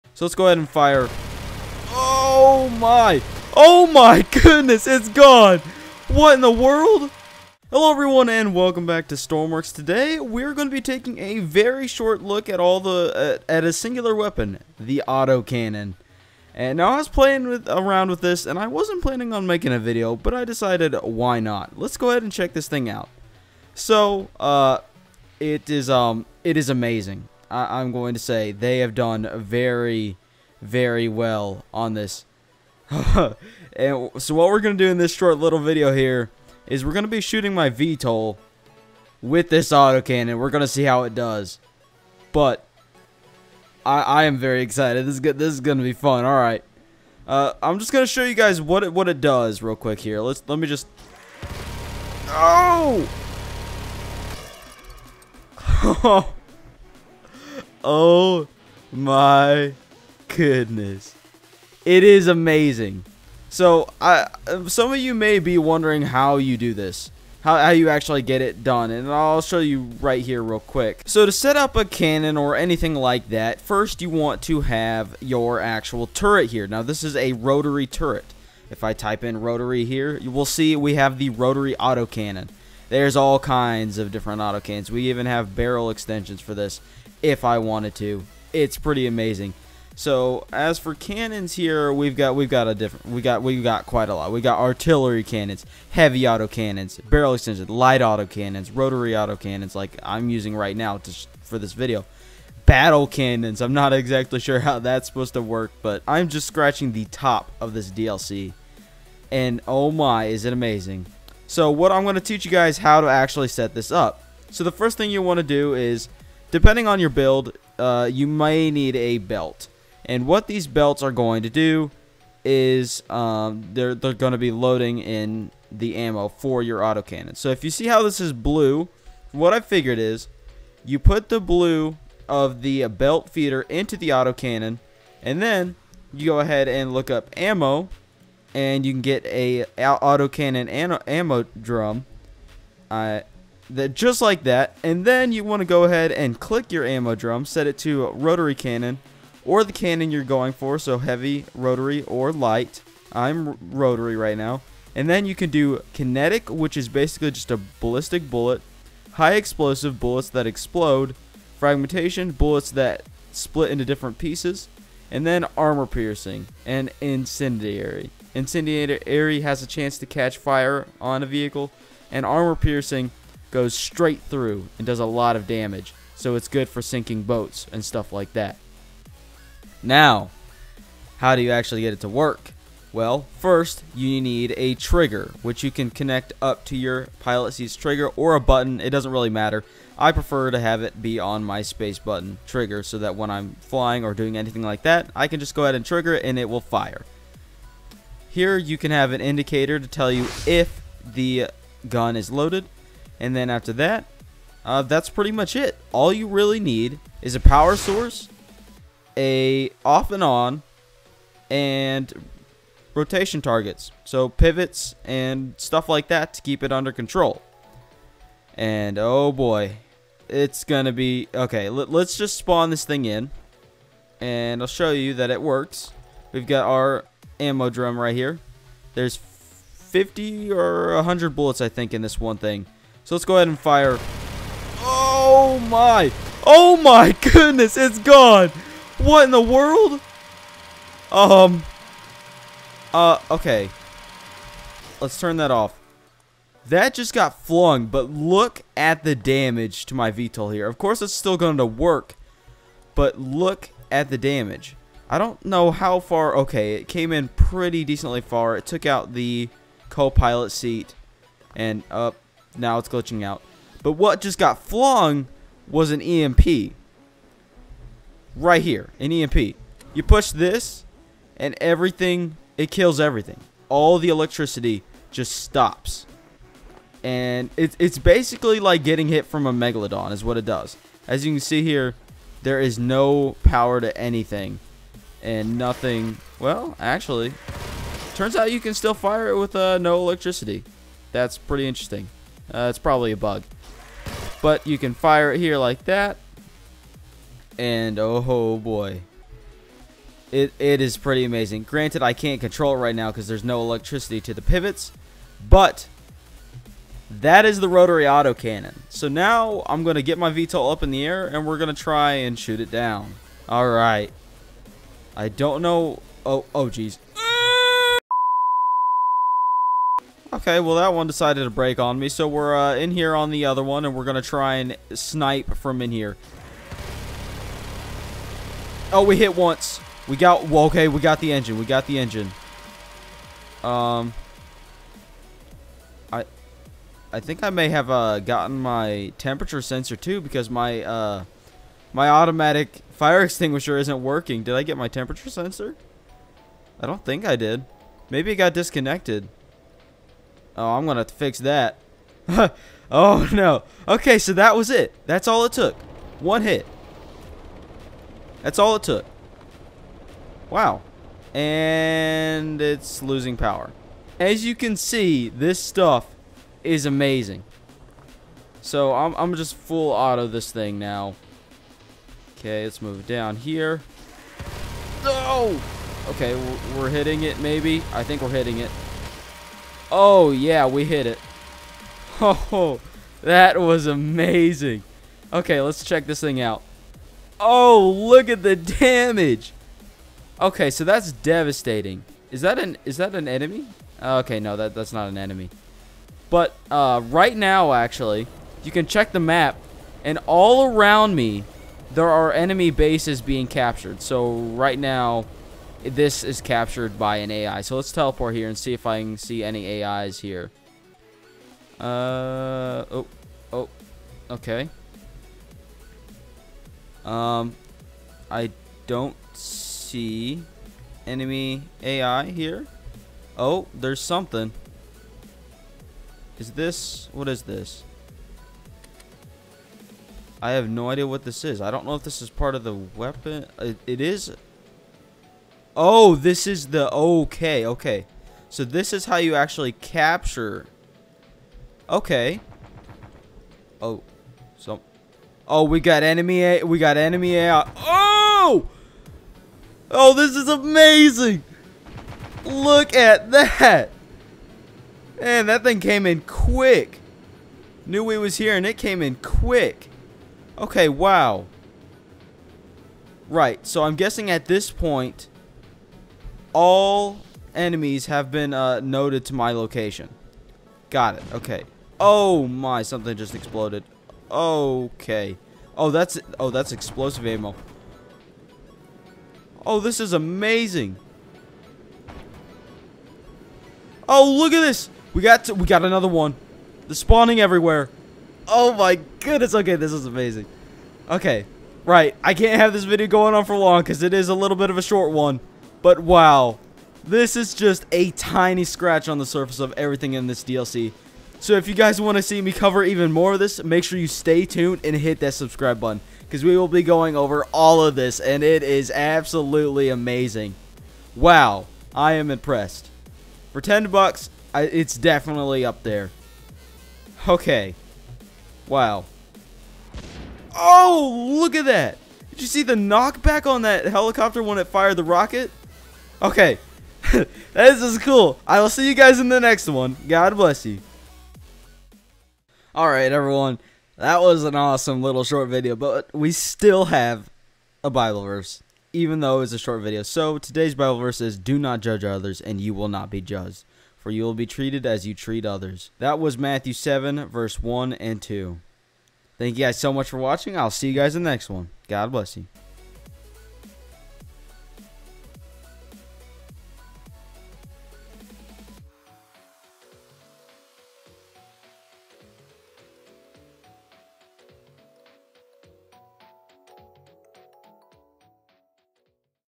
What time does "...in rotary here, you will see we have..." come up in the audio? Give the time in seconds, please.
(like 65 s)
79 s.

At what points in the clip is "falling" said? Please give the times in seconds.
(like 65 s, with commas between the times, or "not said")
not said.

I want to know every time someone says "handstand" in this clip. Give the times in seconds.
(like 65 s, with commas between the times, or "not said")
not said.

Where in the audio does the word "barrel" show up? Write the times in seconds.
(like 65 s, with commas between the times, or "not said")
85 s, 97 s.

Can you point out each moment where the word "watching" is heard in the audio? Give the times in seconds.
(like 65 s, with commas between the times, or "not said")
550 s.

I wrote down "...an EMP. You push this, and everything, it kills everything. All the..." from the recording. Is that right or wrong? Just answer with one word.
right.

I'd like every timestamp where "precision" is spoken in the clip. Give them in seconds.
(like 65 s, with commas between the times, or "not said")
not said.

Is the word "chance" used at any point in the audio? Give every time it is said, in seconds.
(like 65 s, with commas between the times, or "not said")
169 s.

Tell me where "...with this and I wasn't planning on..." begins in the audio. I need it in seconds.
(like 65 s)
18 s.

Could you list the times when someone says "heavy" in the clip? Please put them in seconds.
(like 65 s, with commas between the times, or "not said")
95 s, 150 s.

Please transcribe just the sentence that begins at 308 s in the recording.
So now I'm going to get my VTOL up in the air and we're going to try and shoot it down.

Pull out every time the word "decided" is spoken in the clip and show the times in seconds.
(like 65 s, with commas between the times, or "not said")
20 s, 321 s.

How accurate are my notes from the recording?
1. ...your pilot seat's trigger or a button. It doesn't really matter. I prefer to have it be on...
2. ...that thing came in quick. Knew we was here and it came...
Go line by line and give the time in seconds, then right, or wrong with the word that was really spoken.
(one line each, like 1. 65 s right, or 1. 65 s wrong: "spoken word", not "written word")
1. 186 s right
2. 455 s right.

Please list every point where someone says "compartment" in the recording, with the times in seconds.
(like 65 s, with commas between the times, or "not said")
not said.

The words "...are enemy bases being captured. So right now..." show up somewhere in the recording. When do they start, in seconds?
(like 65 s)
402 s.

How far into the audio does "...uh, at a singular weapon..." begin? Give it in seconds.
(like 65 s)
13 s.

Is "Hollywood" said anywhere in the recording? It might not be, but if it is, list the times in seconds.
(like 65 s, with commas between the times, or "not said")
not said.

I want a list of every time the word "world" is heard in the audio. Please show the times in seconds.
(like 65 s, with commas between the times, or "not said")
6 s, 239 s.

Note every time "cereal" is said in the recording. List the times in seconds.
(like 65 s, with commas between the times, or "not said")
not said.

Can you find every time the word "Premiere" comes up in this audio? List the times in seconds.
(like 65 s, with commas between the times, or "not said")
not said.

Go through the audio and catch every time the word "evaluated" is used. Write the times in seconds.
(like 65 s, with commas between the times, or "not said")
not said.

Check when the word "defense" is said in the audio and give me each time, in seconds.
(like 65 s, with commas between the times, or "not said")
not said.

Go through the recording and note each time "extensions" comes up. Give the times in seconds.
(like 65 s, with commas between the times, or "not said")
85 s, 97 s.